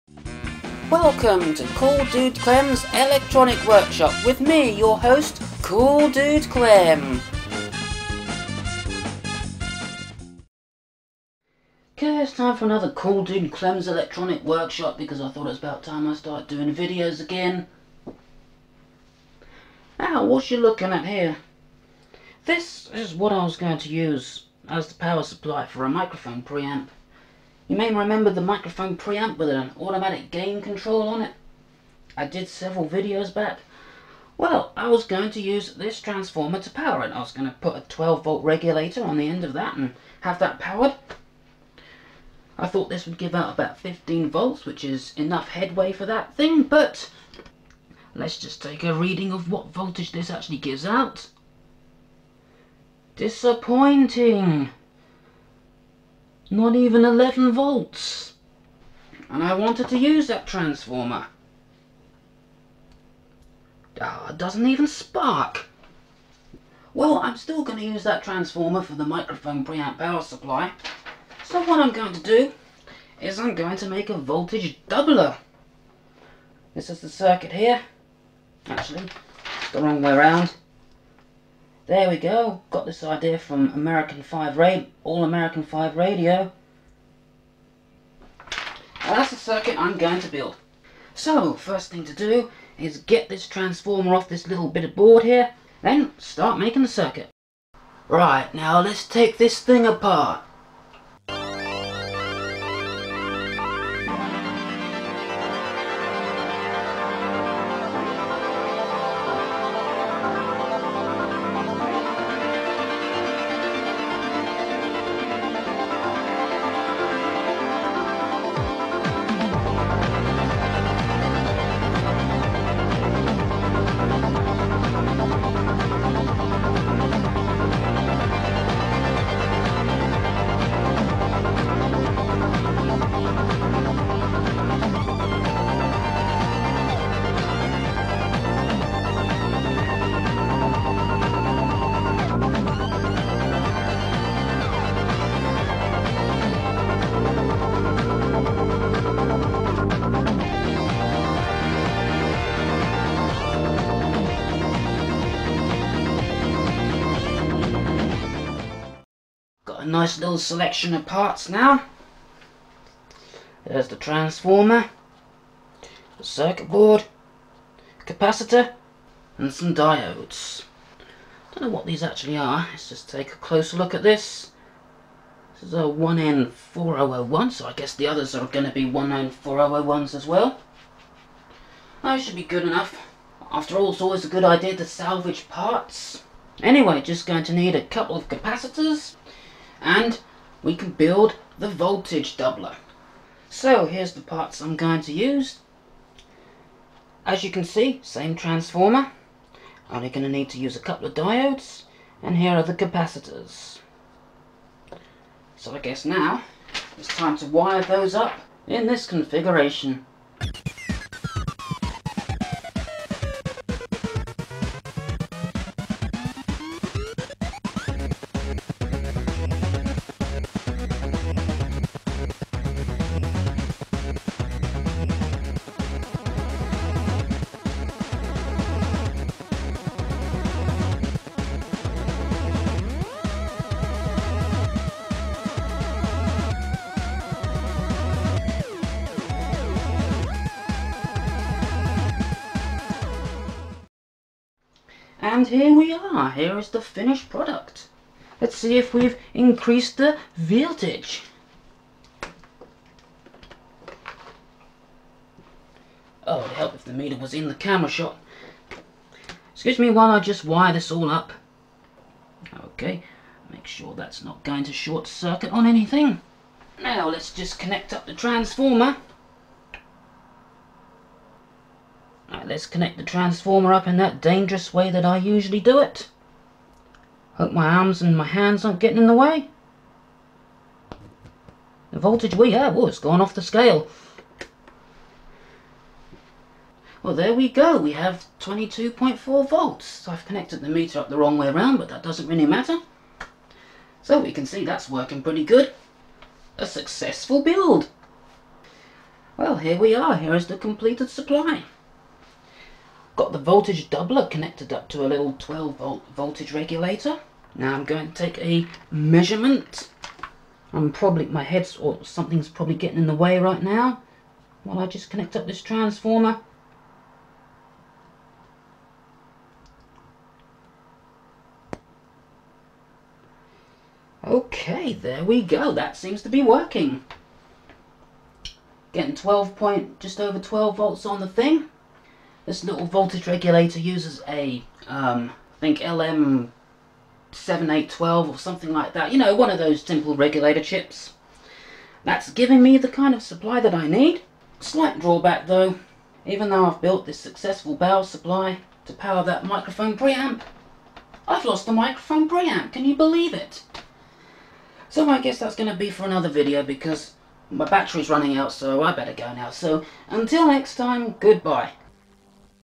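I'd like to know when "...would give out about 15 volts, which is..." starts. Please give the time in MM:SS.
00:43.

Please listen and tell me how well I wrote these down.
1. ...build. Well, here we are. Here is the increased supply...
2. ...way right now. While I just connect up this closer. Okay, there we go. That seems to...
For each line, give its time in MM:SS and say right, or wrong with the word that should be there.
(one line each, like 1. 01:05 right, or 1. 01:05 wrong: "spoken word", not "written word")
1. 04:57 wrong: "completed", not "increased"
2. 05:13 wrong: "transformer", not "closer".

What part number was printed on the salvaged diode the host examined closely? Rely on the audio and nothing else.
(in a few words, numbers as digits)
1N4001.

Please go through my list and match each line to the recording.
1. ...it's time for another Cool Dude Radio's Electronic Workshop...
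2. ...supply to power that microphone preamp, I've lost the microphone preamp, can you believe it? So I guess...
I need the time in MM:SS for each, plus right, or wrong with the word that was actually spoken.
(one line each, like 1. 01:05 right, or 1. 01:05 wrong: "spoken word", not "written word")
1. 00:12 wrong: "Clem", not "Radio"
2. 05:48 right.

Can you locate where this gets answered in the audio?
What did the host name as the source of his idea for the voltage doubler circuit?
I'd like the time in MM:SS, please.
01:25.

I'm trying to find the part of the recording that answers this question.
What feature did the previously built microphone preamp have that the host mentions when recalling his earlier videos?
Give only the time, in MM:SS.
00:29.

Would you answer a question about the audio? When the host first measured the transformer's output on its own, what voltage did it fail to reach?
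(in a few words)
11 volts.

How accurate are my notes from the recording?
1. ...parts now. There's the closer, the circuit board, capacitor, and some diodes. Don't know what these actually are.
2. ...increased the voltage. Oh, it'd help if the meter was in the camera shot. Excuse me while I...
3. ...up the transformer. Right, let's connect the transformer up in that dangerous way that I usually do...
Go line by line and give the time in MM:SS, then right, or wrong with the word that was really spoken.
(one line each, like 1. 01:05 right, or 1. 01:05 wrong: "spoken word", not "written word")
1. 02:41 wrong: "transformer", not "closer"
2. 04:09 right
3. 04:27 right.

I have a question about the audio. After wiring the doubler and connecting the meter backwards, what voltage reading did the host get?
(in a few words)
22.4 volts.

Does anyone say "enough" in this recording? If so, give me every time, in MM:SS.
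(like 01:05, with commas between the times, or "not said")
00:45, 03:02.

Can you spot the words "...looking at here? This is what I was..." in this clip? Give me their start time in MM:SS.
00:20.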